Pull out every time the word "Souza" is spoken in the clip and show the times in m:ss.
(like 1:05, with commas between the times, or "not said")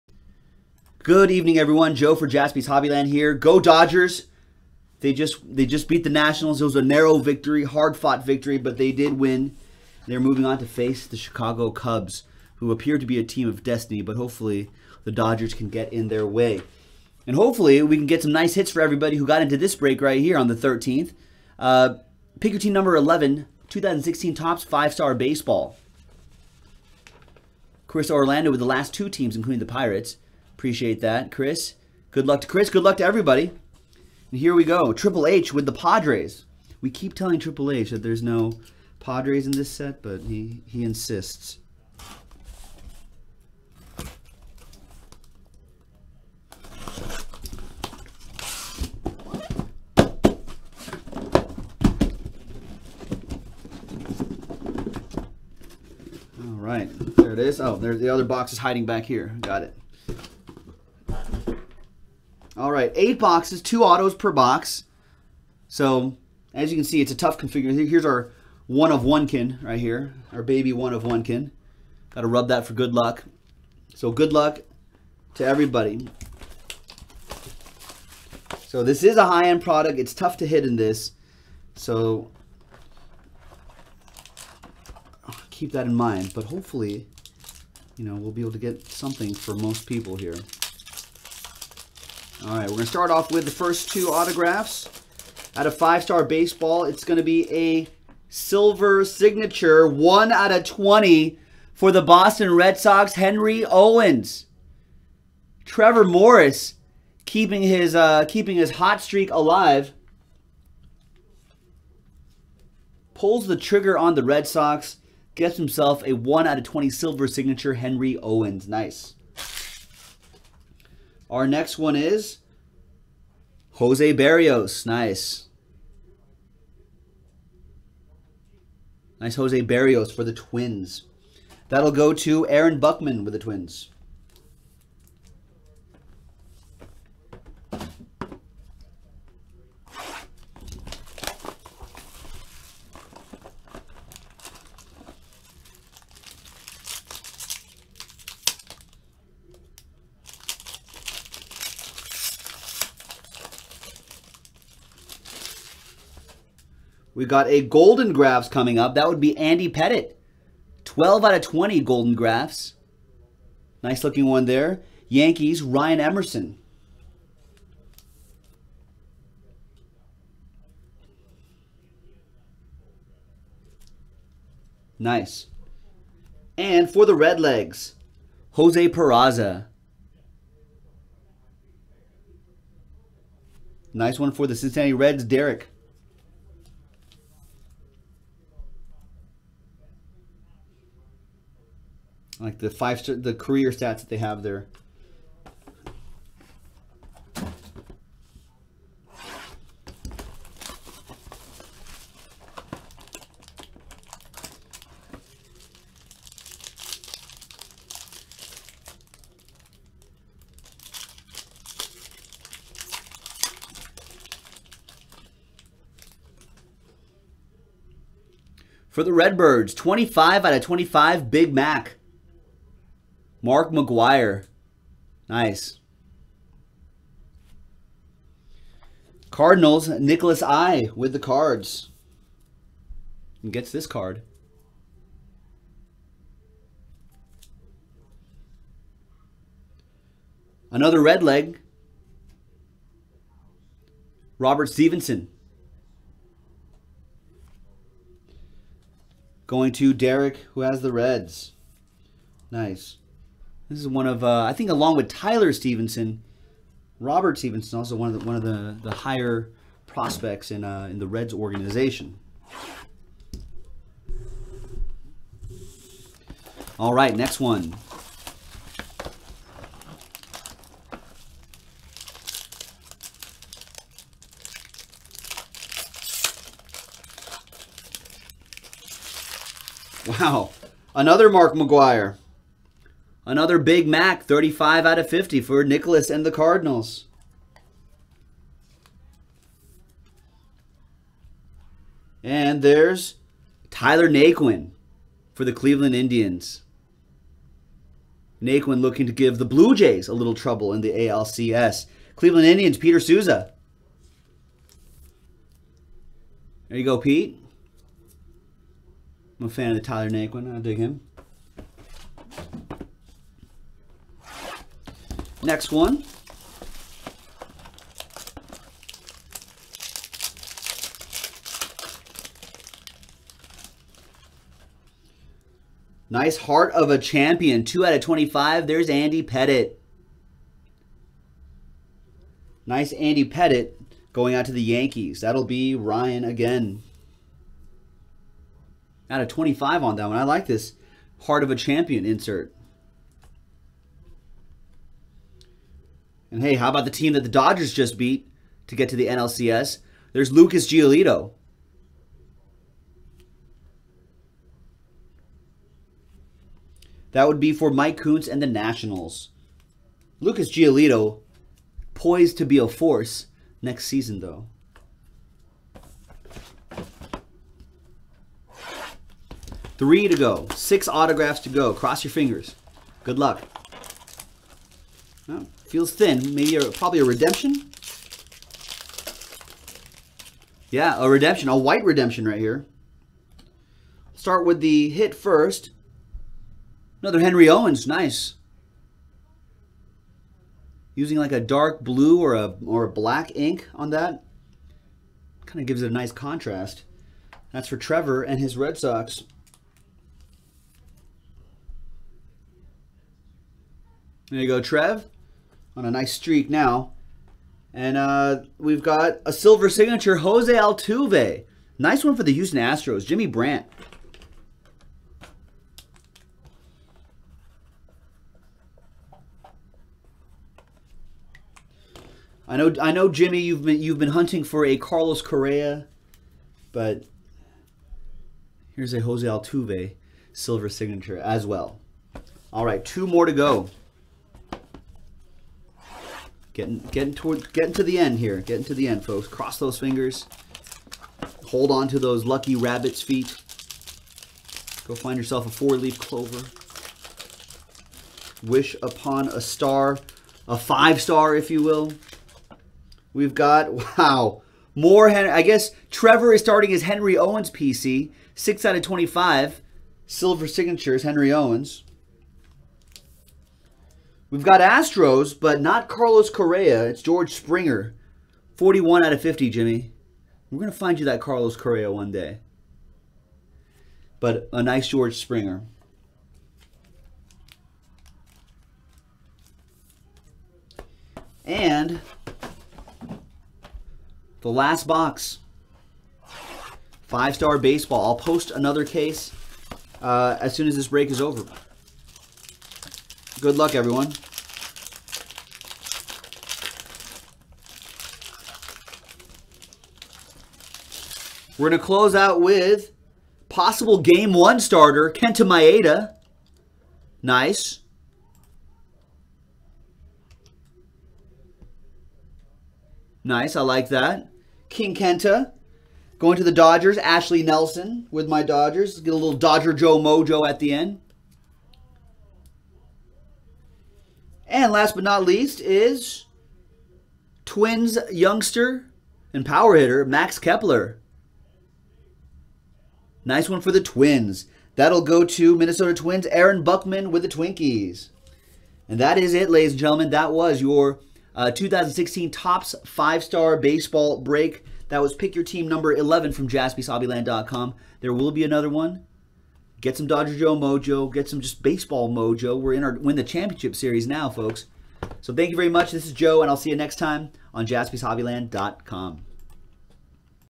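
5:02.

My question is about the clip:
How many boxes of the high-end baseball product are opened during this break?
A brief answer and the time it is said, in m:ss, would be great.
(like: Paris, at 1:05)
8, at 1:02.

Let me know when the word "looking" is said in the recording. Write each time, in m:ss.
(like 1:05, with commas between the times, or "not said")
2:44, 4:58.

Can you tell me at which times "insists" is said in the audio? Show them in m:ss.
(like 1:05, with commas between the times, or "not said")
0:40.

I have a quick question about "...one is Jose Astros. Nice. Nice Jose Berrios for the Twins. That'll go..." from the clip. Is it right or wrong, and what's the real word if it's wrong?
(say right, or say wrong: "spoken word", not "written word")
wrong: "Berrios", not "Astros".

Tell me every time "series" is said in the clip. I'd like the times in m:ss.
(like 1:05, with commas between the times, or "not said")
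9:13.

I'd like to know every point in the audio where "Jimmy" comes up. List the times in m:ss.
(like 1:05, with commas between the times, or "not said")
6:53, 7:03, 7:49.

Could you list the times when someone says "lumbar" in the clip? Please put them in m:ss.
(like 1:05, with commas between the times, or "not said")
not said.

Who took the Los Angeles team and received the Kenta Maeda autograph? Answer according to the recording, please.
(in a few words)
Ashley Nelson.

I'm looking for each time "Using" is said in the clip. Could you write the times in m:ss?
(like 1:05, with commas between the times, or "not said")
6:30.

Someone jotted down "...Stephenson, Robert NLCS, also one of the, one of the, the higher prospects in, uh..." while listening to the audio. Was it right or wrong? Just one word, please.
wrong.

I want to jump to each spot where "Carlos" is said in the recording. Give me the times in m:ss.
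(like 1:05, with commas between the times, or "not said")
7:04, 7:45, 7:51.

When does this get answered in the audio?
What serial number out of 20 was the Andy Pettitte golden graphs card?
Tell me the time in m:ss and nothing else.
2:40.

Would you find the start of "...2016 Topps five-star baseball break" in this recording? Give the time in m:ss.
9:01.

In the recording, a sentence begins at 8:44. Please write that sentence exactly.
And last but not least is Twins youngster and power hitter Max Kepler.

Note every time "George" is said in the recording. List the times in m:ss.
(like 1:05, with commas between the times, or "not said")
7:47, 7:54.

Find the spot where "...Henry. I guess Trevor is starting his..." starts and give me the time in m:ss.
7:35.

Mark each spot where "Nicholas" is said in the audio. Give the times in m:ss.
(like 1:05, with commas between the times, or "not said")
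3:49, 4:45.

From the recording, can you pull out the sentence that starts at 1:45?
Trevor Morris keeping his, uh, keeping his hot streak alive.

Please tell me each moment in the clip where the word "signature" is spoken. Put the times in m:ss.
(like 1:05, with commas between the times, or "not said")
1:39, 1:57, 6:49, 7:10, 7:40.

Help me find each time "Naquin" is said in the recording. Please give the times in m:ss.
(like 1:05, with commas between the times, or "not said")
4:54, 4:58, 5:10.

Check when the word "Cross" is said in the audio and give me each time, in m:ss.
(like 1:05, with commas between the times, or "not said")
6:11, 7:19.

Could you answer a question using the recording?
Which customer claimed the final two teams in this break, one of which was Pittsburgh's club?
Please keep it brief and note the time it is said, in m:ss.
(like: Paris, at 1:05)
Chris Orlando, at 0:27.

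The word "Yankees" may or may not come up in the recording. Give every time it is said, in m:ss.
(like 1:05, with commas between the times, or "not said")
2:45, 5:34.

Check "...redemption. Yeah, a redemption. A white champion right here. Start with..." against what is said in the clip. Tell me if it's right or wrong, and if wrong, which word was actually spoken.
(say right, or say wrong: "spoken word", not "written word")
wrong: "redemption", not "champion".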